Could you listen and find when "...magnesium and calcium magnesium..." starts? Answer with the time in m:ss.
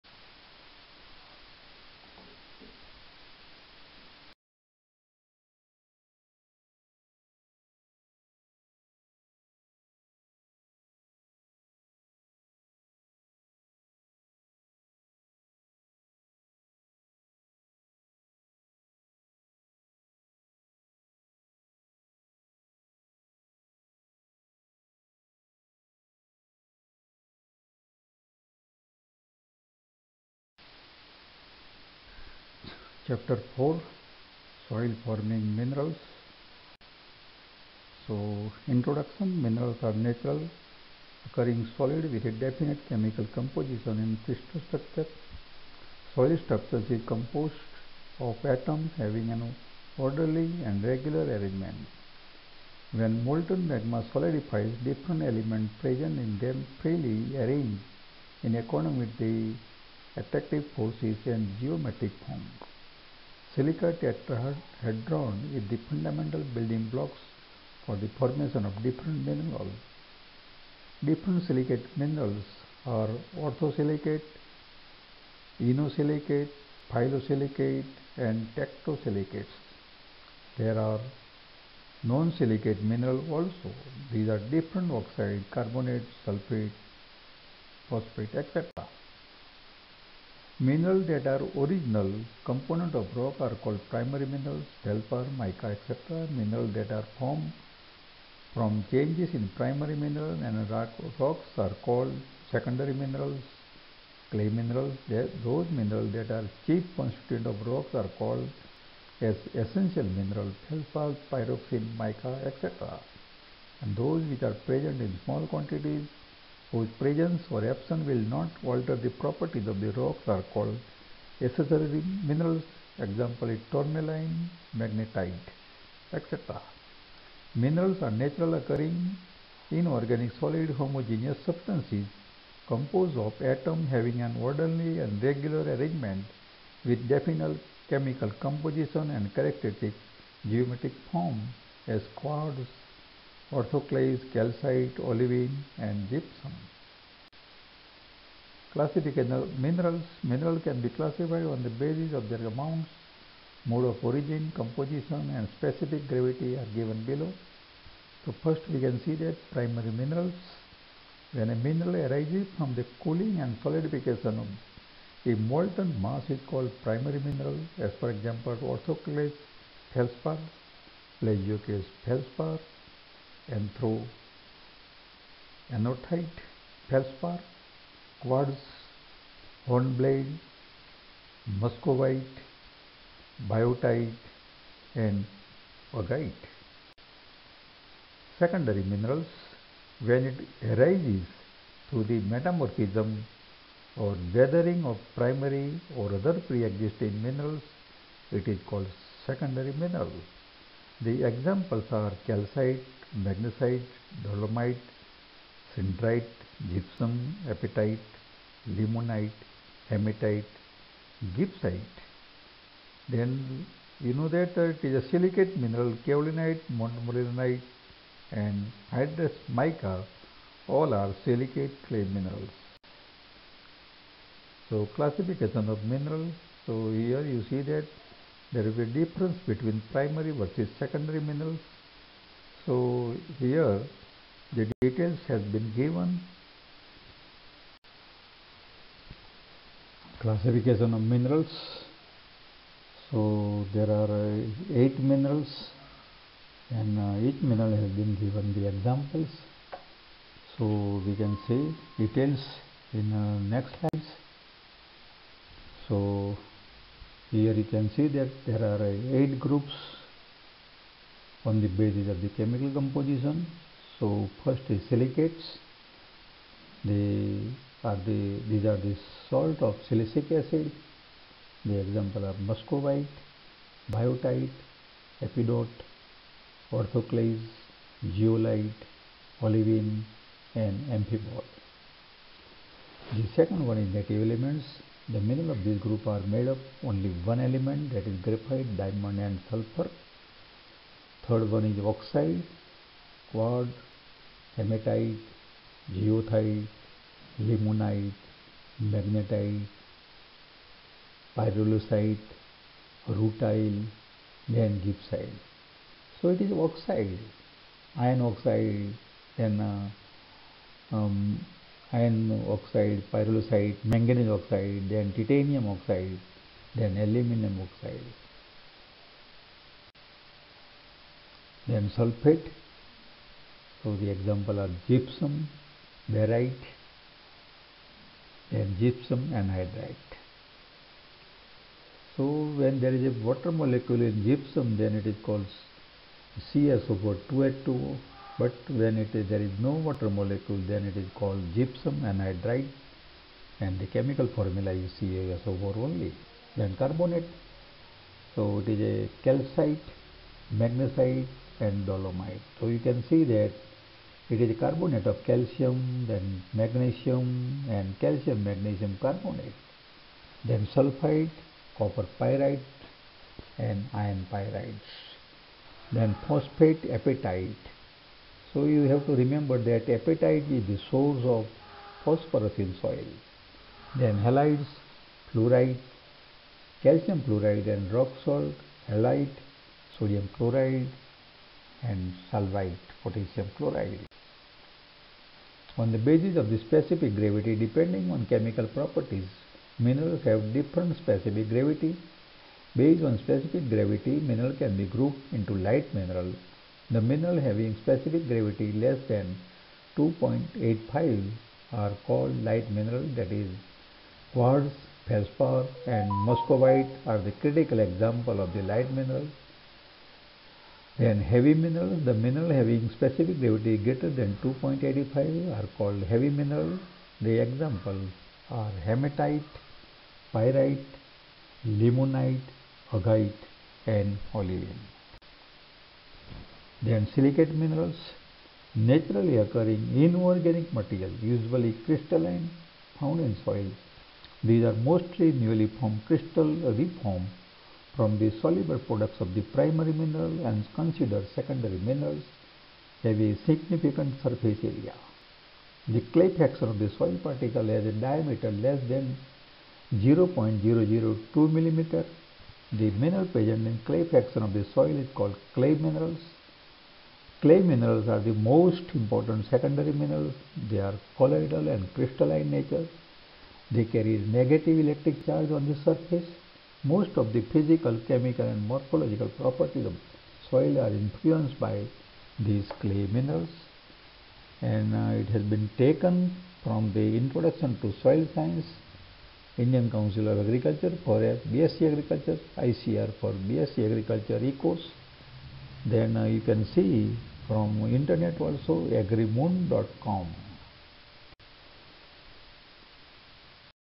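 5:56.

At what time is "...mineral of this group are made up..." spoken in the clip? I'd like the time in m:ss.
4:45.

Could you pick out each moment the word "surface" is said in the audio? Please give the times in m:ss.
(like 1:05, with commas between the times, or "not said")
7:24, 7:45.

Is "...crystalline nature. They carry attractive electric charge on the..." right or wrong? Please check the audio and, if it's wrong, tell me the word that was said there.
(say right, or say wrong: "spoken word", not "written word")
wrong: "negative", not "attractive".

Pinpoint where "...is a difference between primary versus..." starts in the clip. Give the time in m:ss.
3:48.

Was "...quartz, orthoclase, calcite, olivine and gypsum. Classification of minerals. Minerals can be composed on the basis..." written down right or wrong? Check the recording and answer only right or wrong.
wrong.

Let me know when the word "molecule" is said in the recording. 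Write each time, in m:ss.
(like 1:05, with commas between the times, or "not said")
5:33, 5:40.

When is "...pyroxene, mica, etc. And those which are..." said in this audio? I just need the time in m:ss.
1:51.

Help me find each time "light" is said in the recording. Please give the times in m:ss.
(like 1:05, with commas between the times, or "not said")
6:35, 6:42, 6:48.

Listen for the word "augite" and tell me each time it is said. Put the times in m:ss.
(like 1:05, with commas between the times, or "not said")
3:05, 7:02.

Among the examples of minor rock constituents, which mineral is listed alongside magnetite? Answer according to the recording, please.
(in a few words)
Tourmaline.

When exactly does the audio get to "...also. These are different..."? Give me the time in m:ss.
1:23.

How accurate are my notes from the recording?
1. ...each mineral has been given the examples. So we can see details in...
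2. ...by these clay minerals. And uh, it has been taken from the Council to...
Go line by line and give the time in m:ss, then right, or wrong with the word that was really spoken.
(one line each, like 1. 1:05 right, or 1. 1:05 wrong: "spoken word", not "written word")
1. 4:07 right
2. 7:51 wrong: "Introduction", not "Council".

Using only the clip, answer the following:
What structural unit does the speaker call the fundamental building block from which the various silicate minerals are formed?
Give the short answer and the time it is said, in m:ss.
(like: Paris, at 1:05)
Silica tetrahedron, at 1:03.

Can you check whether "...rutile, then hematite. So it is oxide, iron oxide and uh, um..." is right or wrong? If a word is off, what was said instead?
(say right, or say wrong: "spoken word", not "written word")
wrong: "gibbsite", not "hematite".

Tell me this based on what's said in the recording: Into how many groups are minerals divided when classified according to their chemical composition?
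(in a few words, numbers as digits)
8.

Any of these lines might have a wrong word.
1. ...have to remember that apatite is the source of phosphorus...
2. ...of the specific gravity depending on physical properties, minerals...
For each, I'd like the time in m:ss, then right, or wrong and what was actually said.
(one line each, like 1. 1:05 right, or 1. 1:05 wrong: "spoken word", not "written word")
1. 6:08 right
2. 6:26 wrong: "chemical", not "physical".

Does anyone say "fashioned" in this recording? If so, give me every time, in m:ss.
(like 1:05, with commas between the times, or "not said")
not said.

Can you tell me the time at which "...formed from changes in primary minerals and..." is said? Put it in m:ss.
1:37.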